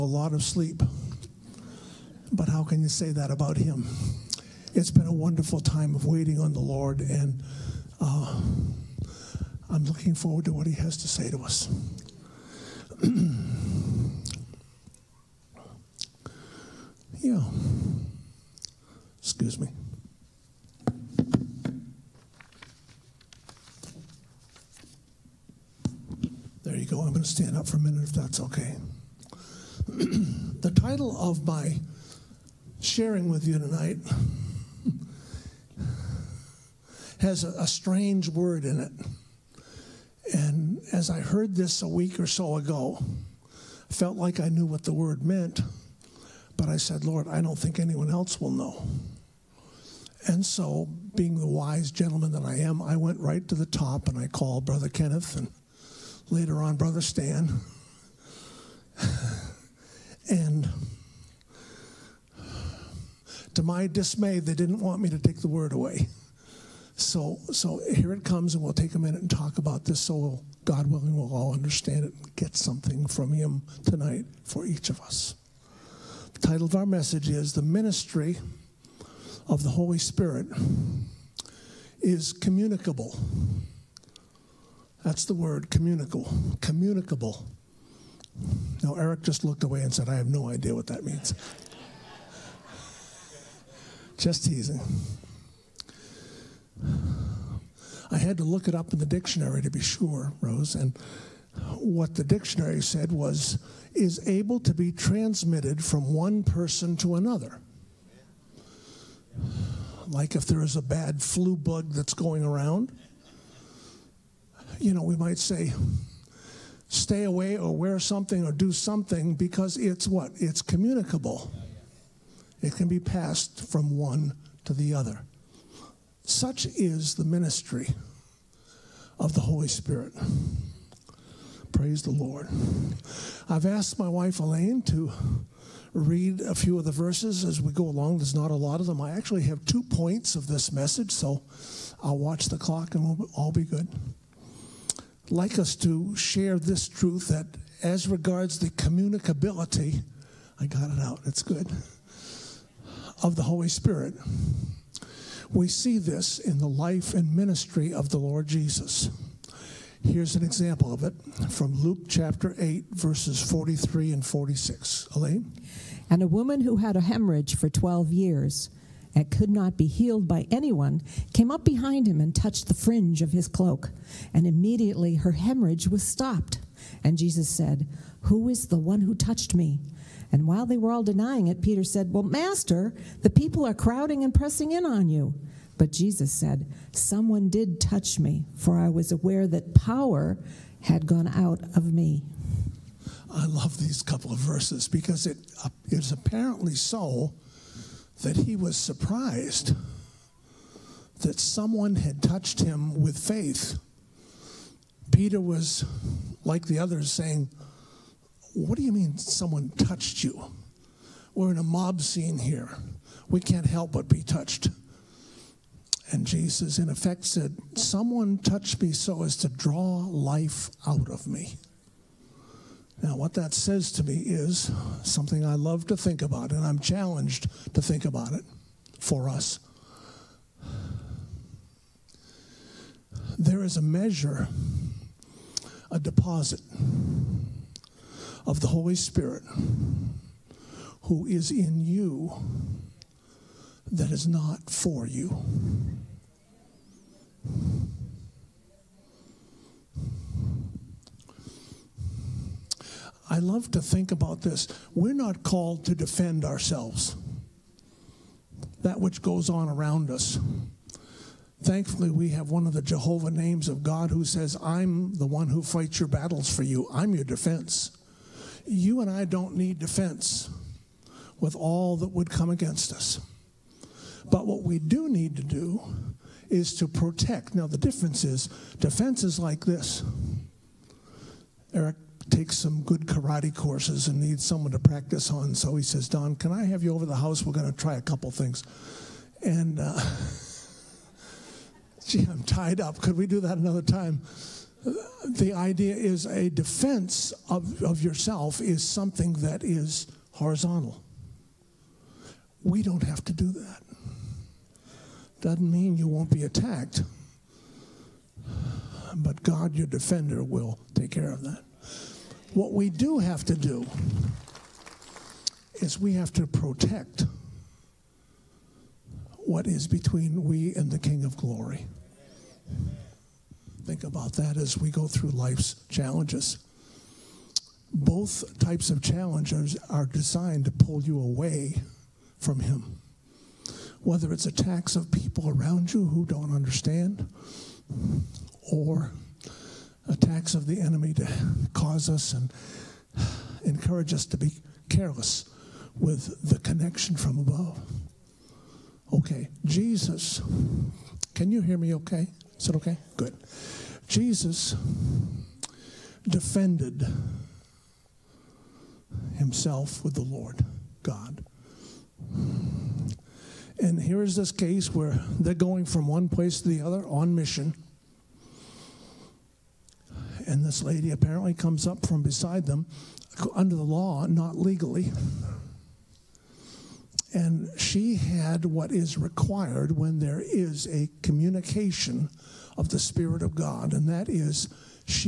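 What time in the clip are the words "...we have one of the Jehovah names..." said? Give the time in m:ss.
4:22.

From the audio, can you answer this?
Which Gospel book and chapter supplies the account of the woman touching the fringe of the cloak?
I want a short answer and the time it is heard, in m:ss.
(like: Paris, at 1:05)
Luke chapter 8, at 2:41.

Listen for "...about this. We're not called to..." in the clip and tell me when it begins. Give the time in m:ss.
4:14.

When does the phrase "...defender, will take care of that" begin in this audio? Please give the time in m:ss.
5:09.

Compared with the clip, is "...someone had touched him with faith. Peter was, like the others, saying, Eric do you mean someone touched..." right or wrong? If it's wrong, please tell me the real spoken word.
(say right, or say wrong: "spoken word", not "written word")
wrong: "What", not "Eric".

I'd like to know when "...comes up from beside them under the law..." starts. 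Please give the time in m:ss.
6:11.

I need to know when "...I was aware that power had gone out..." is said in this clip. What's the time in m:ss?
3:08.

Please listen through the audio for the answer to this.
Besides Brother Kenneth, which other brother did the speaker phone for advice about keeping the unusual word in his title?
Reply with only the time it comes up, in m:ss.
0:56.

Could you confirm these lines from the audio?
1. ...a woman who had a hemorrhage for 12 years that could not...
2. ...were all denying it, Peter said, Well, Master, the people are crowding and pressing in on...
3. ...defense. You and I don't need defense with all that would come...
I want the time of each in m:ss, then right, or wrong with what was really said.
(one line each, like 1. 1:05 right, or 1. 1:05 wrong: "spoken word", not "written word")
1. 2:46 right
2. 3:00 right
3. 4:27 right.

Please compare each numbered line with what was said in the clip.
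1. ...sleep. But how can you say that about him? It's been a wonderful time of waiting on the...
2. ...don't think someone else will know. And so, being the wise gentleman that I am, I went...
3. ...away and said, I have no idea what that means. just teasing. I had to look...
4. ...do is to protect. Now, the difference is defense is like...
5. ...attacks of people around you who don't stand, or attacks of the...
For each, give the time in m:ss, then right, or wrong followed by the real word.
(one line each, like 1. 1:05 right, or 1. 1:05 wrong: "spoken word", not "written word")
1. 0:00 right
2. 0:47 wrong: "anyone", not "someone"
3. 1:29 right
4. 4:35 right
5. 5:34 wrong: "understand", not "stand".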